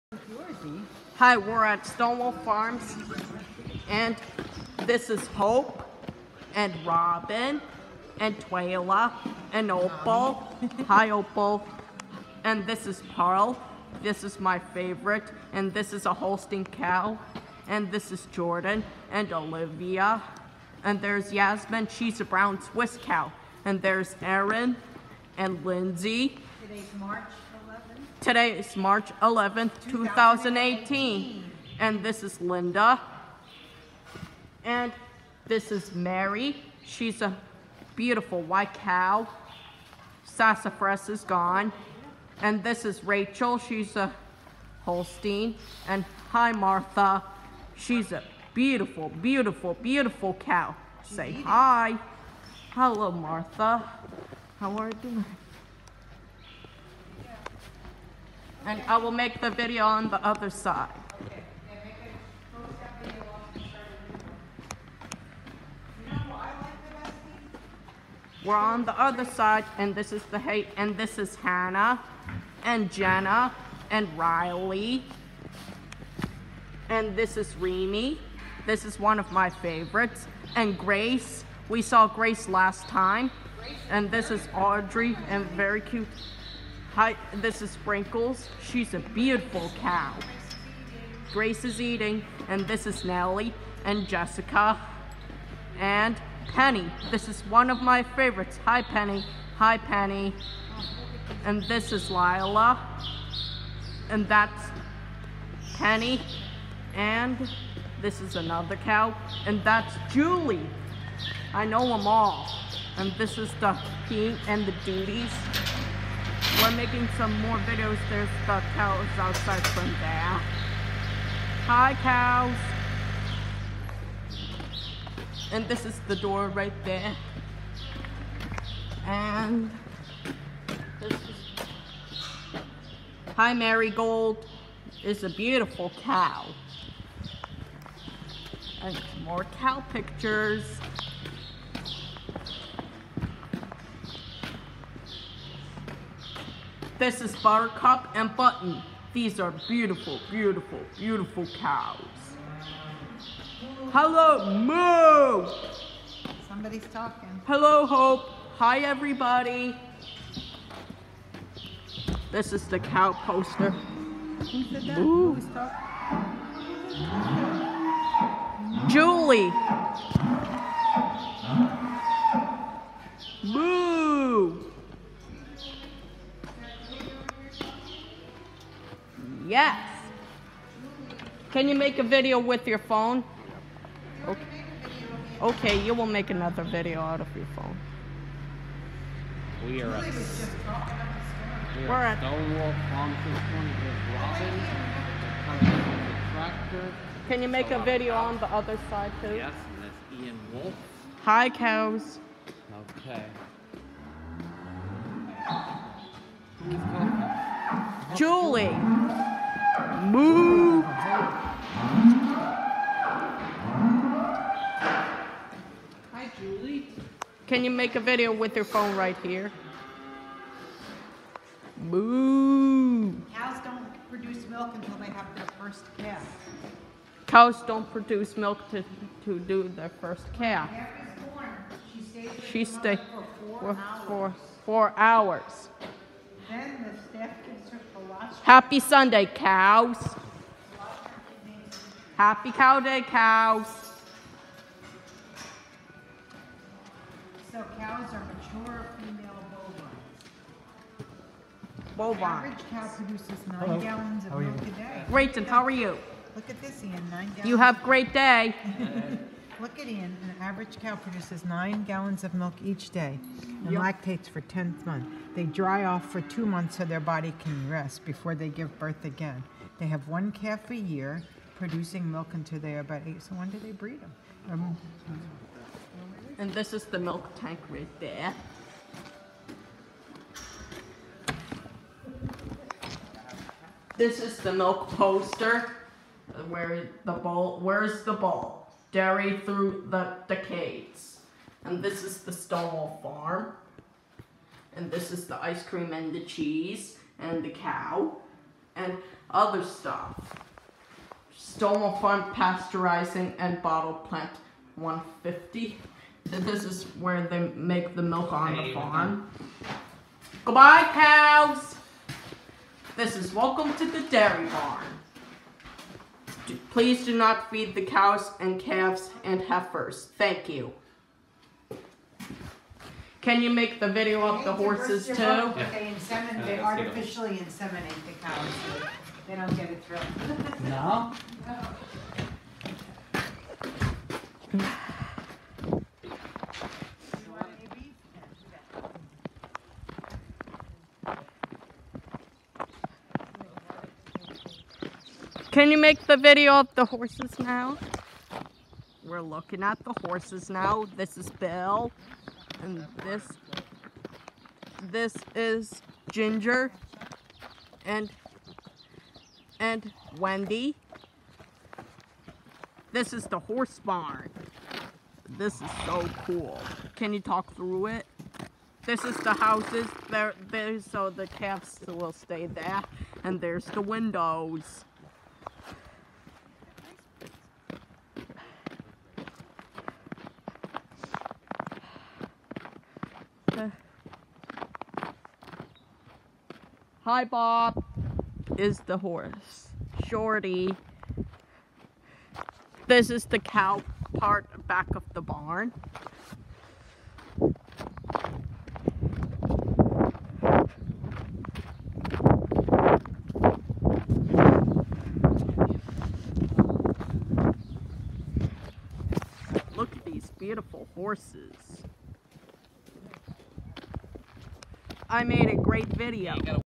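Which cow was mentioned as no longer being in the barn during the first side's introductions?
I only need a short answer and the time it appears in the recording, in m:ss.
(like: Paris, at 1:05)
Sassafras, at 0:40.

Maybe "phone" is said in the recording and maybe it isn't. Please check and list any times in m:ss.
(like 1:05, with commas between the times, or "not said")
3:02, 3:07, 3:38.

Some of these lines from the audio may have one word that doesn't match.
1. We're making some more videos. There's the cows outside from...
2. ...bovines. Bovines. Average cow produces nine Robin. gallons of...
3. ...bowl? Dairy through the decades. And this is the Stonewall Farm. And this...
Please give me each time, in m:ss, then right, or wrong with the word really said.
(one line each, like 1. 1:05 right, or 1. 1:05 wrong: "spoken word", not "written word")
1. 1:56 right
2. 4:11 wrong: "Hello", not "Robin"
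3. 4:48 right.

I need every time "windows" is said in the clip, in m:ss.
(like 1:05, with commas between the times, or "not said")
6:13.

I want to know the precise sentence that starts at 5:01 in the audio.
Stonewall Farm Pasteurizing and Bottle Plant 150.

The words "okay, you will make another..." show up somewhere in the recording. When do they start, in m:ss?
3:05.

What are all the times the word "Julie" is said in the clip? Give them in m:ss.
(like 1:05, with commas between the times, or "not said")
1:50, 2:48, 3:28, 3:36.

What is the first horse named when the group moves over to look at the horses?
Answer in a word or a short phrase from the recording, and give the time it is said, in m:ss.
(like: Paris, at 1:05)
Bill, at 5:51.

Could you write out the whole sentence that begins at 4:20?
An average cow produces nine gallons of milk each day and yep.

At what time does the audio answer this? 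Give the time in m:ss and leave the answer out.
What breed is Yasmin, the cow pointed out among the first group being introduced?
0:22.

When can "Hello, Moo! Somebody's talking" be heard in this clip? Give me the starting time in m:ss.
2:33.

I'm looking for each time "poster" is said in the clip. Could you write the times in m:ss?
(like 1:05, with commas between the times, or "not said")
2:43, 4:44.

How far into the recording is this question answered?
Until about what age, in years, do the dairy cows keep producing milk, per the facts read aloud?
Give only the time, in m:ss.
4:33.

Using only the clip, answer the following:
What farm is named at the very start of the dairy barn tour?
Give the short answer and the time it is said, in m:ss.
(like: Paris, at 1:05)
Stonewall Farms, at 0:01.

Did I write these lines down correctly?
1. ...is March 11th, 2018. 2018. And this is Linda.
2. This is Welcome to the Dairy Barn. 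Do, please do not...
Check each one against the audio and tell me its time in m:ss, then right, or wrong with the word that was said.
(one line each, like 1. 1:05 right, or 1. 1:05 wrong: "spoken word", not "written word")
1. 0:28 right
2. 5:12 right.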